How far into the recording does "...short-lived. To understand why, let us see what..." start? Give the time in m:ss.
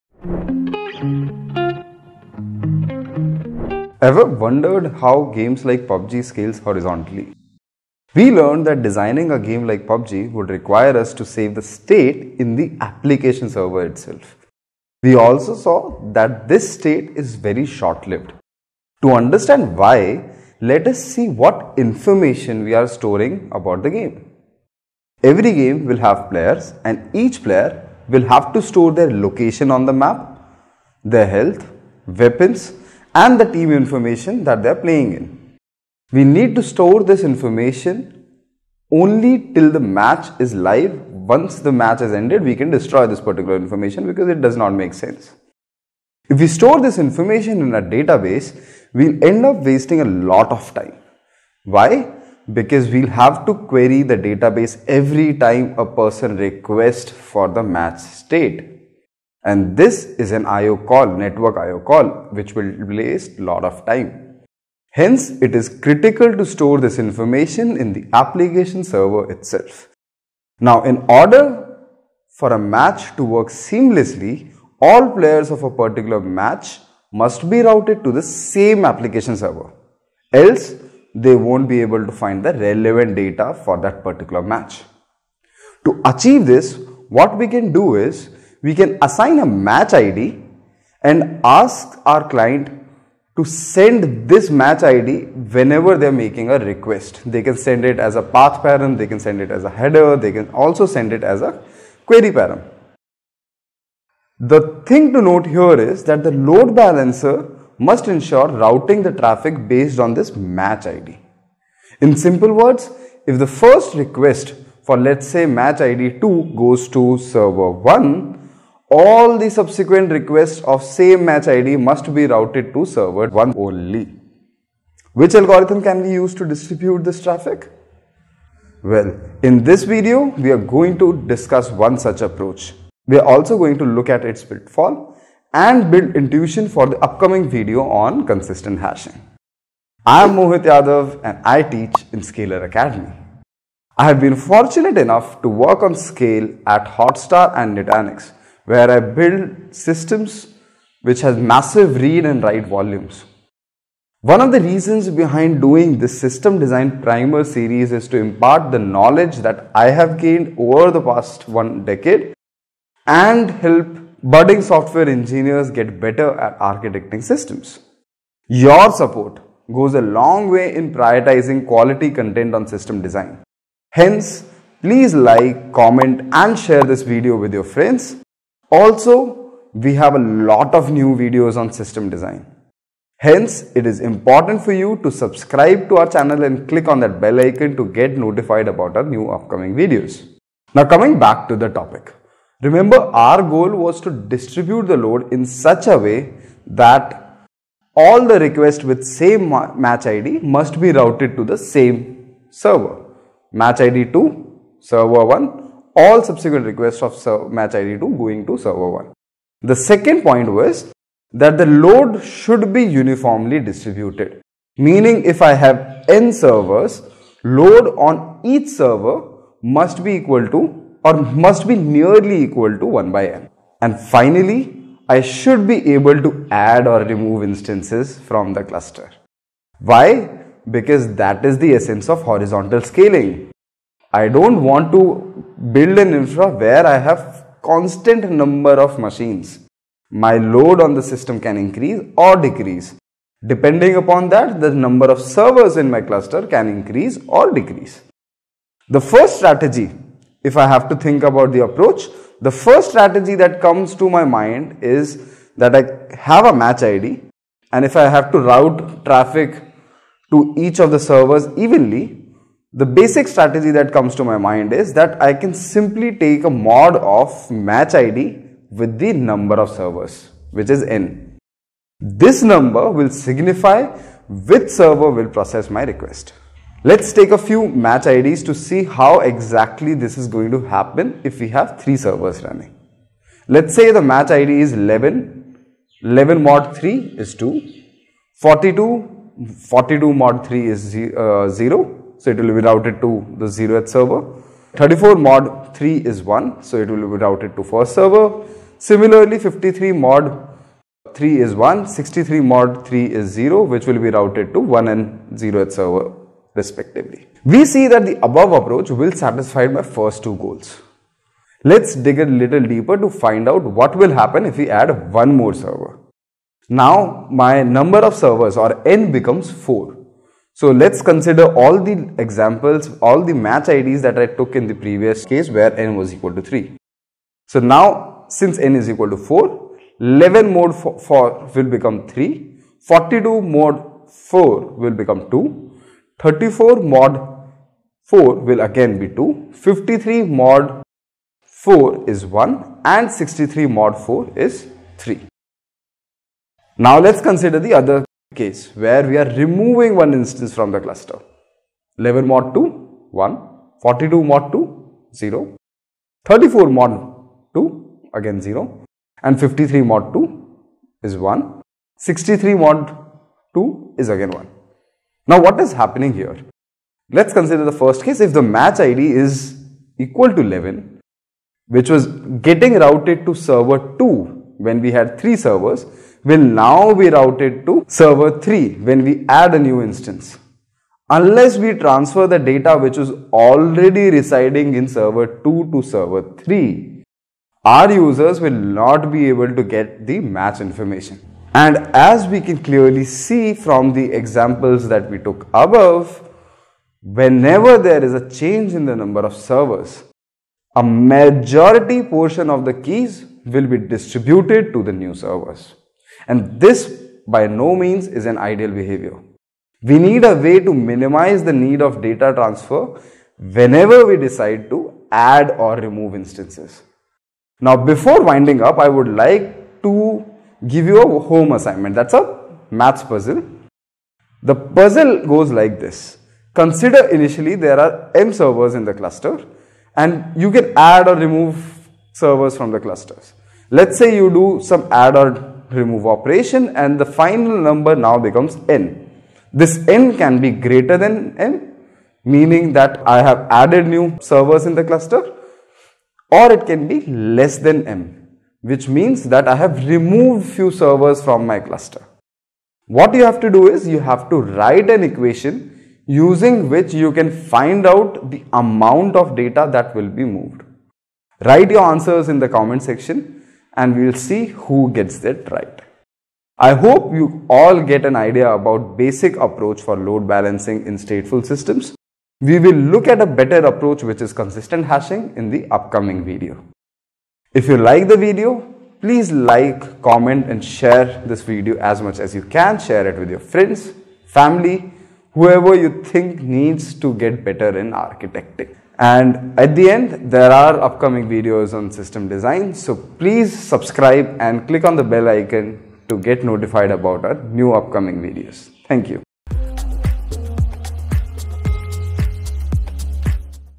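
0:17.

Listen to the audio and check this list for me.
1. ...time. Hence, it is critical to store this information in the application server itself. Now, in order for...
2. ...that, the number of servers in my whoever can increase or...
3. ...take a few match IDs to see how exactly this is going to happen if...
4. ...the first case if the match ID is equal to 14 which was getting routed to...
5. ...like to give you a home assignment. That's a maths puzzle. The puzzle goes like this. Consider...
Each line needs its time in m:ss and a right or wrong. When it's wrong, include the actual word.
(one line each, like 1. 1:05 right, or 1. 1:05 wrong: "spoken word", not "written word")
1. 1:03 right
2. 4:04 wrong: "cluster", not "whoever"
3. 4:37 right
4. 6:07 wrong: "11", not "14"
5. 6:59 right.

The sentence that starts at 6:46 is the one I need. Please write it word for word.
And this by no means is an ideal behavior.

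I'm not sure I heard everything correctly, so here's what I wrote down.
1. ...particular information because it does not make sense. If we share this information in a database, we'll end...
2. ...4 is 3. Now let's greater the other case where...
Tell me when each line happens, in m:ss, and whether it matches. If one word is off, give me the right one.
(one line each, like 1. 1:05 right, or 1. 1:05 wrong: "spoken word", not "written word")
1. 0:43 wrong: "store", not "share"
2. 5:44 wrong: "consider", not "greater".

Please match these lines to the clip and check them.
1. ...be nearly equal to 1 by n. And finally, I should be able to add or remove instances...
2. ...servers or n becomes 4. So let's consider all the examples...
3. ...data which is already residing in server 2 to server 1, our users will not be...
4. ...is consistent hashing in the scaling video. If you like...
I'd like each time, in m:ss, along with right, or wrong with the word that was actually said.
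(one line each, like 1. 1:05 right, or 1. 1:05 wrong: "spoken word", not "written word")
1. 3:41 right
2. 5:18 right
3. 6:22 wrong: "3", not "1"
4. 7:54 wrong: "upcoming", not "scaling".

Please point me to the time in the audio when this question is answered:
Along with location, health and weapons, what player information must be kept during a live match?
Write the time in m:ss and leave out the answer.
0:33.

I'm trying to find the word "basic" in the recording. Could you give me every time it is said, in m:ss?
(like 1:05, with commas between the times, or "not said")
4:22, 7:48.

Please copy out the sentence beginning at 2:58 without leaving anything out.
Also, we have a lot of new videos on system design.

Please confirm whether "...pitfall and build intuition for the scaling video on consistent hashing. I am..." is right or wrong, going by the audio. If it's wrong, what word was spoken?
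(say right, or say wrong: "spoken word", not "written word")
wrong: "upcoming", not "scaling".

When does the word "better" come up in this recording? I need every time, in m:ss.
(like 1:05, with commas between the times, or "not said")
2:45, 7:53, 8:07.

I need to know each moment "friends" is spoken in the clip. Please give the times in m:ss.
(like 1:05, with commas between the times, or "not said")
2:57, 8:03.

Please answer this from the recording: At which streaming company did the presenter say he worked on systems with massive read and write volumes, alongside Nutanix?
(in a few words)
Hotstar.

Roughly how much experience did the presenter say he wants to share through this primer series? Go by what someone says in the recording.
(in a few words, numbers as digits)
one decade.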